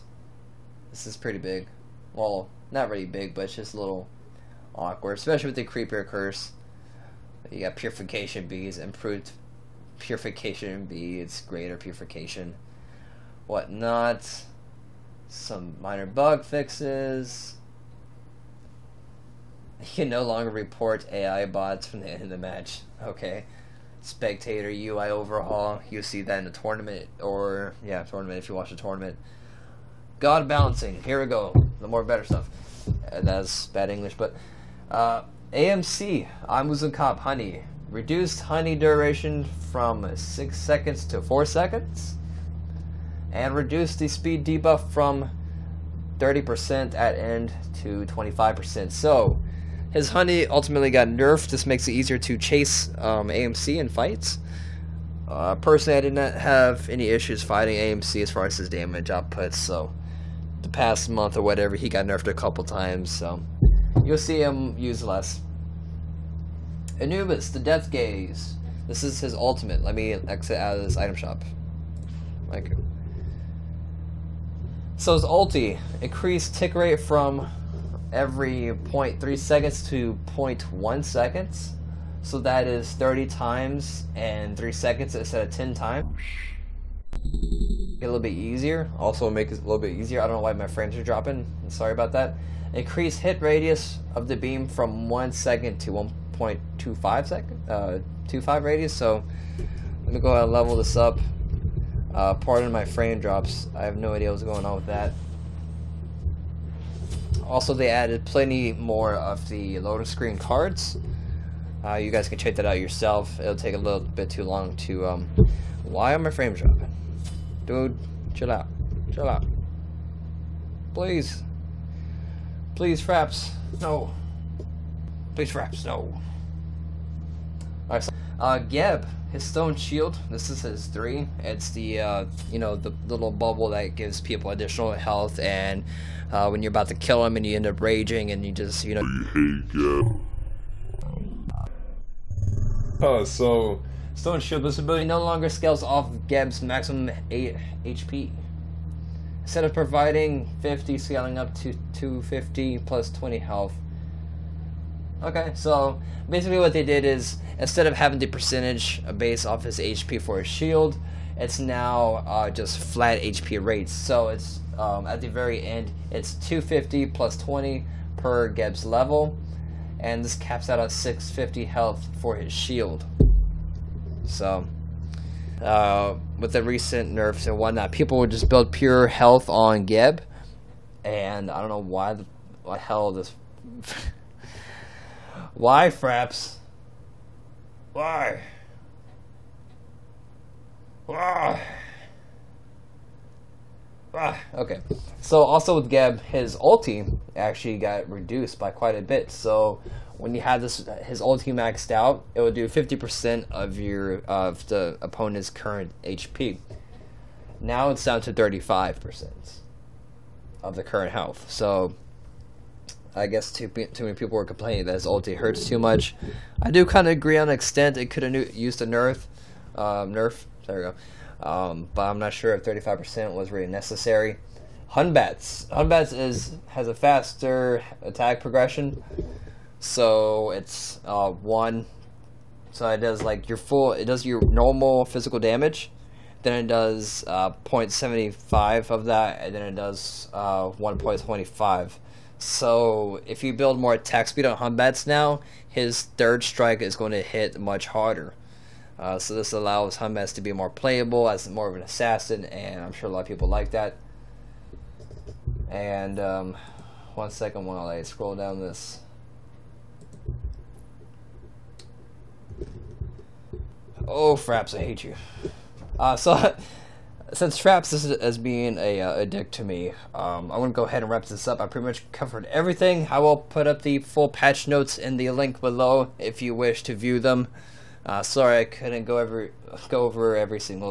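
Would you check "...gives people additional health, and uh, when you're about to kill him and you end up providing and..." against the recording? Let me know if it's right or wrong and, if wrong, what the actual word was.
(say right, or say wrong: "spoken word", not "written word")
wrong: "raging", not "providing".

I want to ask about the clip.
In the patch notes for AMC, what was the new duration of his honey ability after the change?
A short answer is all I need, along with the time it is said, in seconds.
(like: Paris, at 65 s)
4 seconds, at 41 s.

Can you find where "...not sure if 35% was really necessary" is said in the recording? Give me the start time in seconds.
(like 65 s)
222 s.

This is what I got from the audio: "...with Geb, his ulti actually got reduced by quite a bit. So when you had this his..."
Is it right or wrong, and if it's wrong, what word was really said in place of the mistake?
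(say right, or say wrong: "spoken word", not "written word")
right.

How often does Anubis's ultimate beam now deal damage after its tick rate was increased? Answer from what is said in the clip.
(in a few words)
every 0.1 seconds.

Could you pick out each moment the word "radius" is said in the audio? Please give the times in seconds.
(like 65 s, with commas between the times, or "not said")
93 s, 98 s.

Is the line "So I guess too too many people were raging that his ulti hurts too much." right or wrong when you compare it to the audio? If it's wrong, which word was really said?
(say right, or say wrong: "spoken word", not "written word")
wrong: "complaining", not "raging".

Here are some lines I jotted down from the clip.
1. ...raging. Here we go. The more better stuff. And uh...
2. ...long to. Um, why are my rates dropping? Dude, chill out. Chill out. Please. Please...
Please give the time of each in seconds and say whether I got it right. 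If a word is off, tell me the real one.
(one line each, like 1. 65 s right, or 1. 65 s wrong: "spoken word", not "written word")
1. 30 s wrong: "balancing", not "raging"
2. 114 s wrong: "frames", not "rates".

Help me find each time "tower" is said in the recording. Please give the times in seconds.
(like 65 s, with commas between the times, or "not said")
not said.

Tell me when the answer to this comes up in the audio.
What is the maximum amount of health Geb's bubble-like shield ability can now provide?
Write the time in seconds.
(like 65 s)
170 s.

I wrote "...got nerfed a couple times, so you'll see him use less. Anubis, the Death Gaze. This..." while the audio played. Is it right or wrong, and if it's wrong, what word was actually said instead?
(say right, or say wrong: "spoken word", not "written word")
right.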